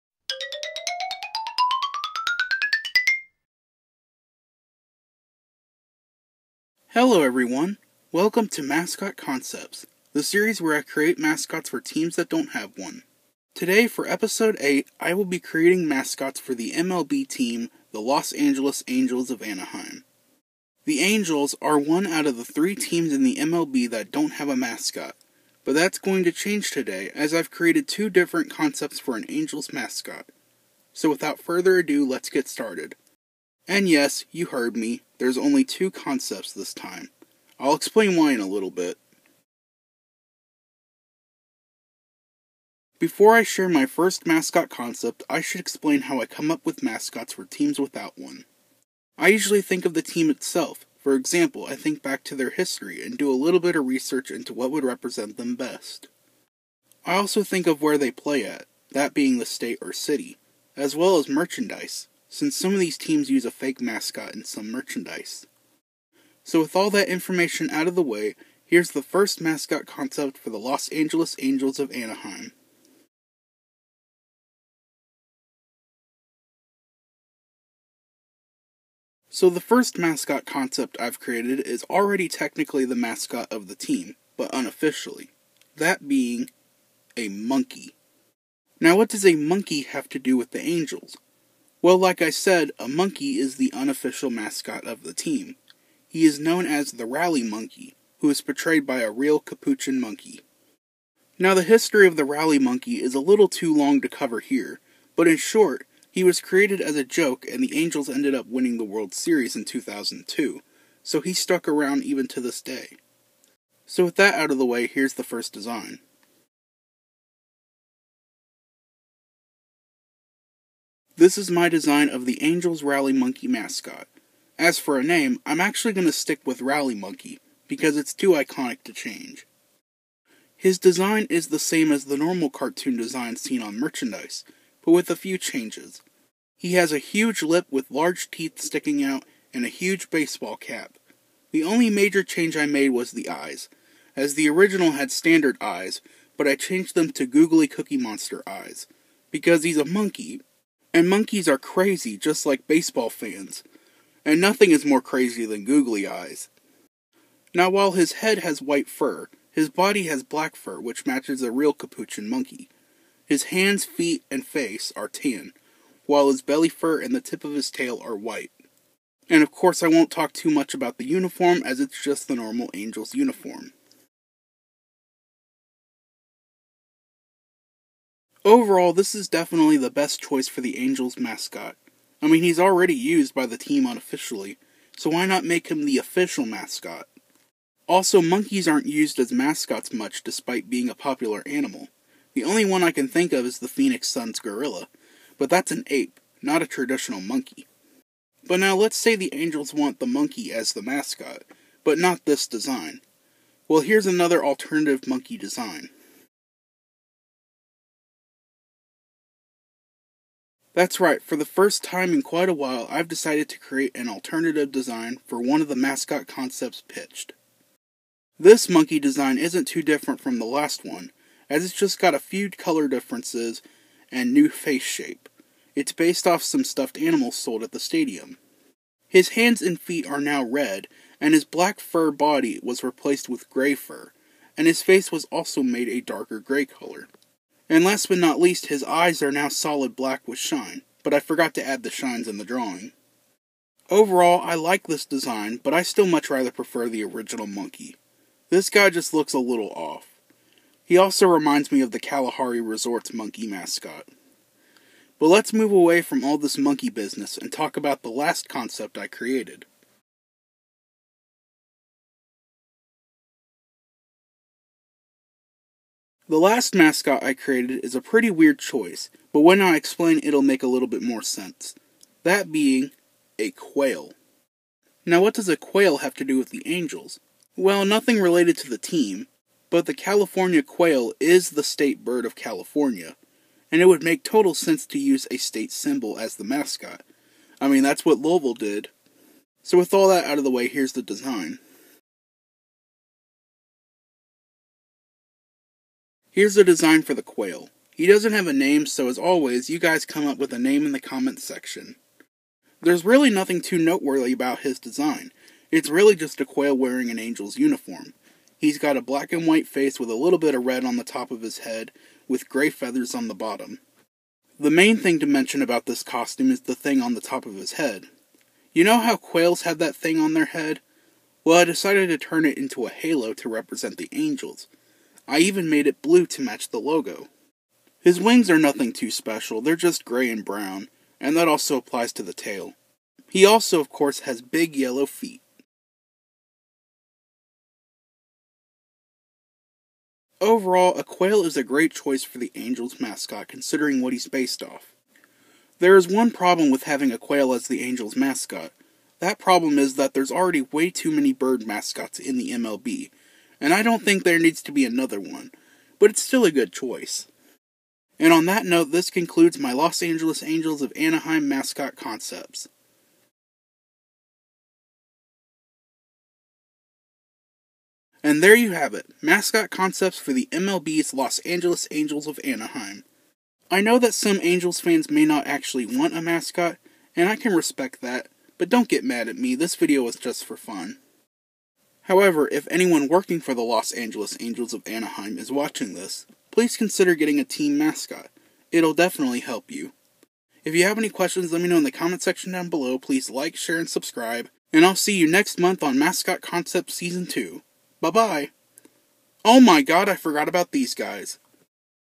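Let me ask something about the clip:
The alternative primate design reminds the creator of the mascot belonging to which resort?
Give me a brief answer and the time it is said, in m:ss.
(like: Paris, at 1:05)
Kalahari Resort, at 4:12.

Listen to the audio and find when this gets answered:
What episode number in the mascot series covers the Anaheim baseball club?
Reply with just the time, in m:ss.
0:14.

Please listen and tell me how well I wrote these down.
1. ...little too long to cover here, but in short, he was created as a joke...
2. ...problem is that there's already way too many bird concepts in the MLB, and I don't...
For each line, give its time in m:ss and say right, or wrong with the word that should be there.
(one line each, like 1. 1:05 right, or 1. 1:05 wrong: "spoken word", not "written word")
1. 1:43 right
2. 5:49 wrong: "mascots", not "concepts".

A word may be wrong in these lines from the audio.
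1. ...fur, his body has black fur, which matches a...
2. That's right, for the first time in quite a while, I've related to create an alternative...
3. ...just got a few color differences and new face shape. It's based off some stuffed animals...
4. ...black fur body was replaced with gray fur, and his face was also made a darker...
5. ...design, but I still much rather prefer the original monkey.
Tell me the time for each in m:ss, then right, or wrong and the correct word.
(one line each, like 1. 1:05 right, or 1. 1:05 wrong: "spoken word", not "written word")
1. 2:38 right
2. 3:30 wrong: "decided", not "related"
3. 3:41 right
4. 3:51 right
5. 4:05 right.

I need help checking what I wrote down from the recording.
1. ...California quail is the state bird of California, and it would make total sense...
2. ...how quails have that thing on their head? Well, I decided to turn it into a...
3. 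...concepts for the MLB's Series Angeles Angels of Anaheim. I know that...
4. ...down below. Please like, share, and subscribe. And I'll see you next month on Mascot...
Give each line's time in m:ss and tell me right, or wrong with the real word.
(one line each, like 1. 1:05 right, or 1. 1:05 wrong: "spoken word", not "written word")
1. 4:39 right
2. 5:18 right
3. 6:09 wrong: "Los", not "Series"
4. 6:32 right.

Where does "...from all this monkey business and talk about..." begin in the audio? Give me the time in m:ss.
4:16.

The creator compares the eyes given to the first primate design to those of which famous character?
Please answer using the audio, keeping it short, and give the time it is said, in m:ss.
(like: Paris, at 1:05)
Cookie Monster, at 2:27.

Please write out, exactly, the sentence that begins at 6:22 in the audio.
However, if anyone working for the Los Angeles Angels of Anaheim is watching this, please consider getting a team mascot.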